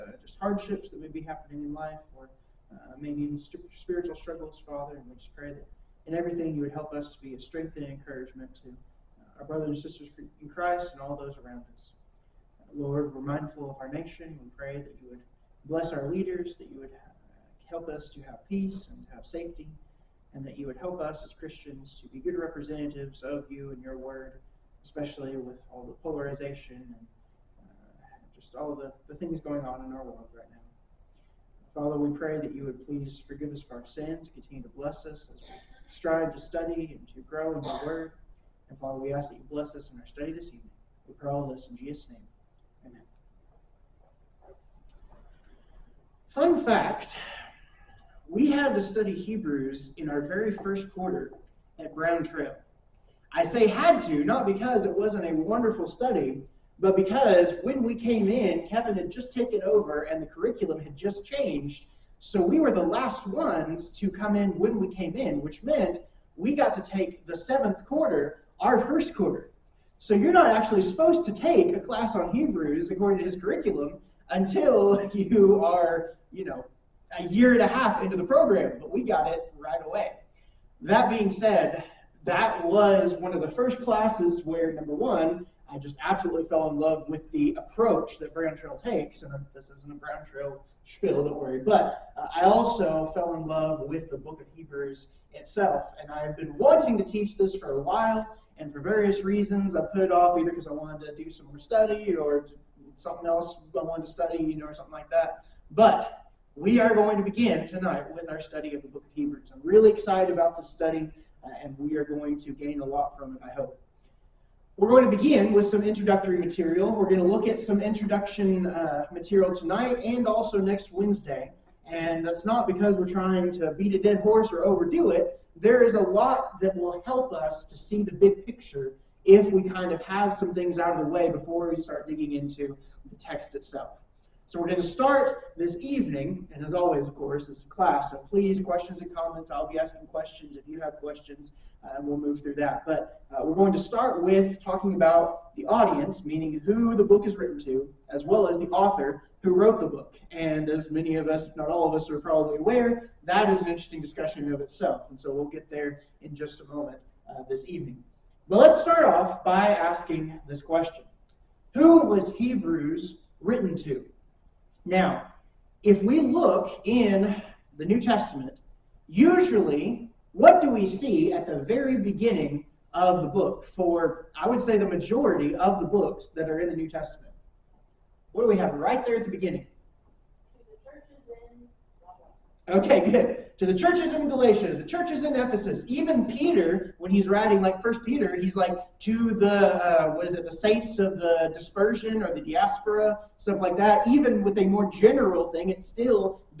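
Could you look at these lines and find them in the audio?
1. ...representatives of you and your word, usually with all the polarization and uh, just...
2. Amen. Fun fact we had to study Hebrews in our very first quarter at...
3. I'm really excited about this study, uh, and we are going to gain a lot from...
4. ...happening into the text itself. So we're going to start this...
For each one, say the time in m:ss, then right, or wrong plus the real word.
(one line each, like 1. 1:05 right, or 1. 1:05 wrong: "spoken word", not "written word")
1. 0:22 wrong: "especially", not "usually"
2. 0:42 right
3. 1:49 right
4. 2:12 wrong: "digging", not "happening".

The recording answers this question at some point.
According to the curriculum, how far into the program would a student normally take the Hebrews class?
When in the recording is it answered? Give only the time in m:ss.
1:17.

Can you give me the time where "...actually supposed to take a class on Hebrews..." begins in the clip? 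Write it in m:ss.
1:10.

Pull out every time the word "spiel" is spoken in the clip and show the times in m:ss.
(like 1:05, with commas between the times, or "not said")
1:30.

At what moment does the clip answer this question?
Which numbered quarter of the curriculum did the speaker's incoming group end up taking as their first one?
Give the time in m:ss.
1:07.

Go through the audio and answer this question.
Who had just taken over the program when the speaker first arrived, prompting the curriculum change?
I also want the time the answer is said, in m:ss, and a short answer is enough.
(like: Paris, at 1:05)
Kevin, at 0:58.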